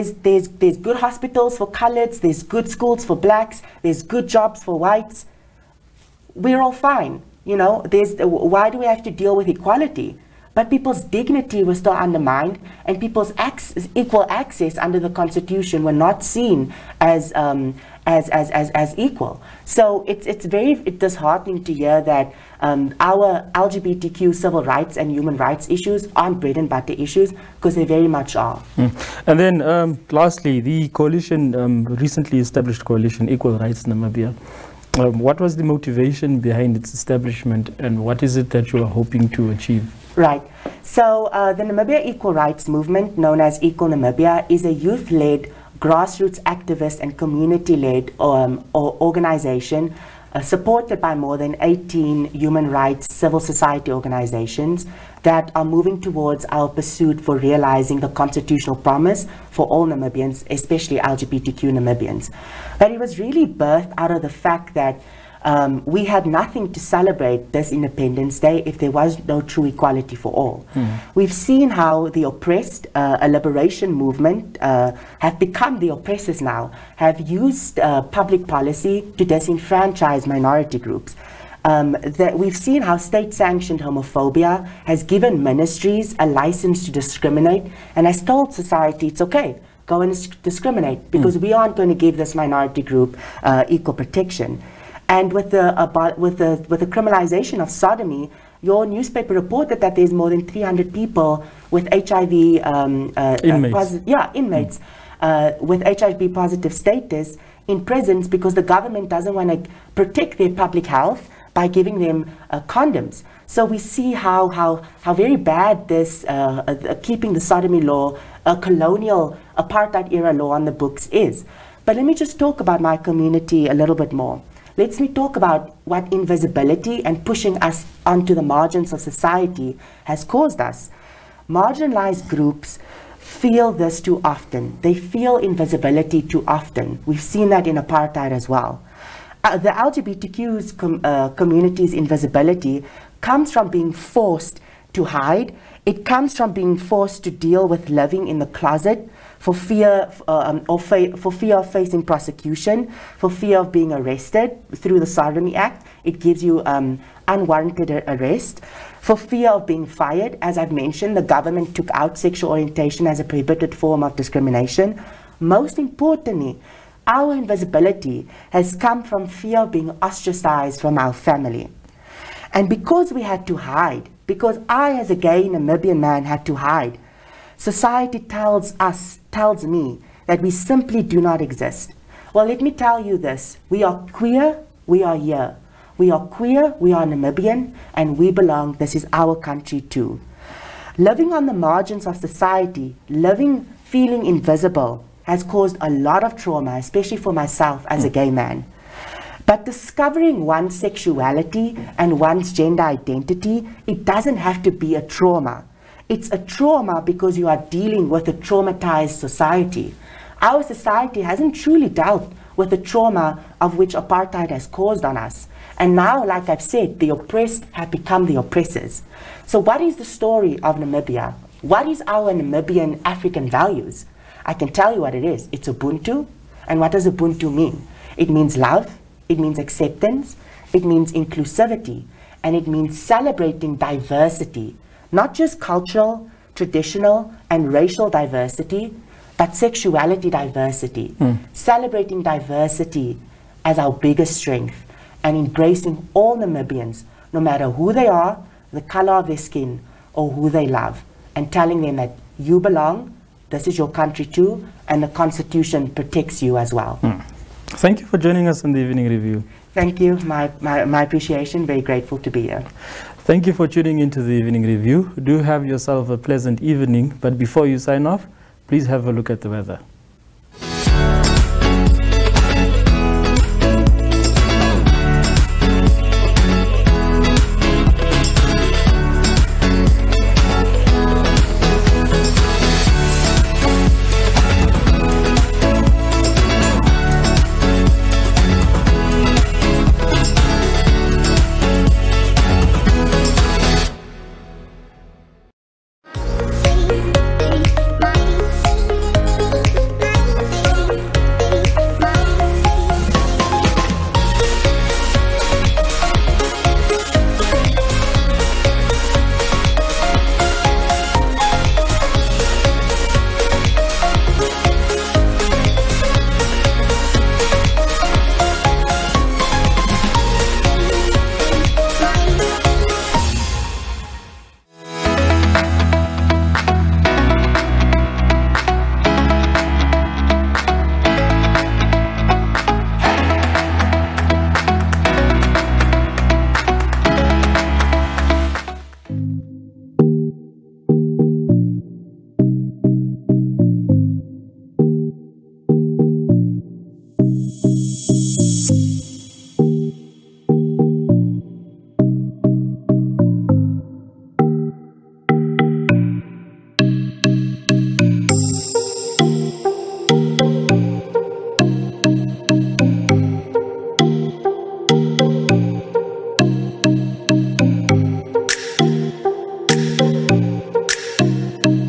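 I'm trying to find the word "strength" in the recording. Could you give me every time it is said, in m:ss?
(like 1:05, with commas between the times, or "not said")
4:04.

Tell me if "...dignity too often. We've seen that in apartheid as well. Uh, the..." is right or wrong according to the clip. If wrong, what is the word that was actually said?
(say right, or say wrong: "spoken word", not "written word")
wrong: "invisibility", not "dignity".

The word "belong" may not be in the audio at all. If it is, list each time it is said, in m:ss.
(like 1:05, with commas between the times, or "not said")
3:08, 4:12.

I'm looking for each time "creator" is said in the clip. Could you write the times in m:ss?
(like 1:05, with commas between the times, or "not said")
not said.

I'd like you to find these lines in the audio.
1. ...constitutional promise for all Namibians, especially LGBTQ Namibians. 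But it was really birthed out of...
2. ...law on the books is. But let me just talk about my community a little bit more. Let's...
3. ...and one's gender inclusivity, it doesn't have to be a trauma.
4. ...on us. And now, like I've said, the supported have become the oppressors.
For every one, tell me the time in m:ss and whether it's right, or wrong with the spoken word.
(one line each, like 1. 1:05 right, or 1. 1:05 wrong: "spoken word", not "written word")
1. 0:58 right
2. 2:00 right
3. 3:21 wrong: "identity", not "inclusivity"
4. 3:35 wrong: "oppressed", not "supported".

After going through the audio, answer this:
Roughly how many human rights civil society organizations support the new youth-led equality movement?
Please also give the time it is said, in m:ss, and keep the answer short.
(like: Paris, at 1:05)
18, at 0:51.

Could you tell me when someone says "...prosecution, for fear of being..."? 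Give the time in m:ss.
2:32.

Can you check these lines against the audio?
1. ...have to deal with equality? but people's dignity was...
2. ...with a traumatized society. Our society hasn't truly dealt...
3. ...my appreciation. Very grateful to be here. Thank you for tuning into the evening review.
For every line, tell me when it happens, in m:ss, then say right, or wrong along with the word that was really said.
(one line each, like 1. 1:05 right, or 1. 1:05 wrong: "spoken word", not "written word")
1. 0:08 right
2. 3:28 right
3. 4:20 right.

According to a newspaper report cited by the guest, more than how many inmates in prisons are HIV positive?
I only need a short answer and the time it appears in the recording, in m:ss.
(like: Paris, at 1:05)
300, at 1:40.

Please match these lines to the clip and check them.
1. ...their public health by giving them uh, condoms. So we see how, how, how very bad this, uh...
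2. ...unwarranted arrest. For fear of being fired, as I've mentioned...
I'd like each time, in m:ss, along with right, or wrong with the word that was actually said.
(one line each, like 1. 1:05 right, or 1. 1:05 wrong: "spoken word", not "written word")
1. 1:50 right
2. 2:37 right.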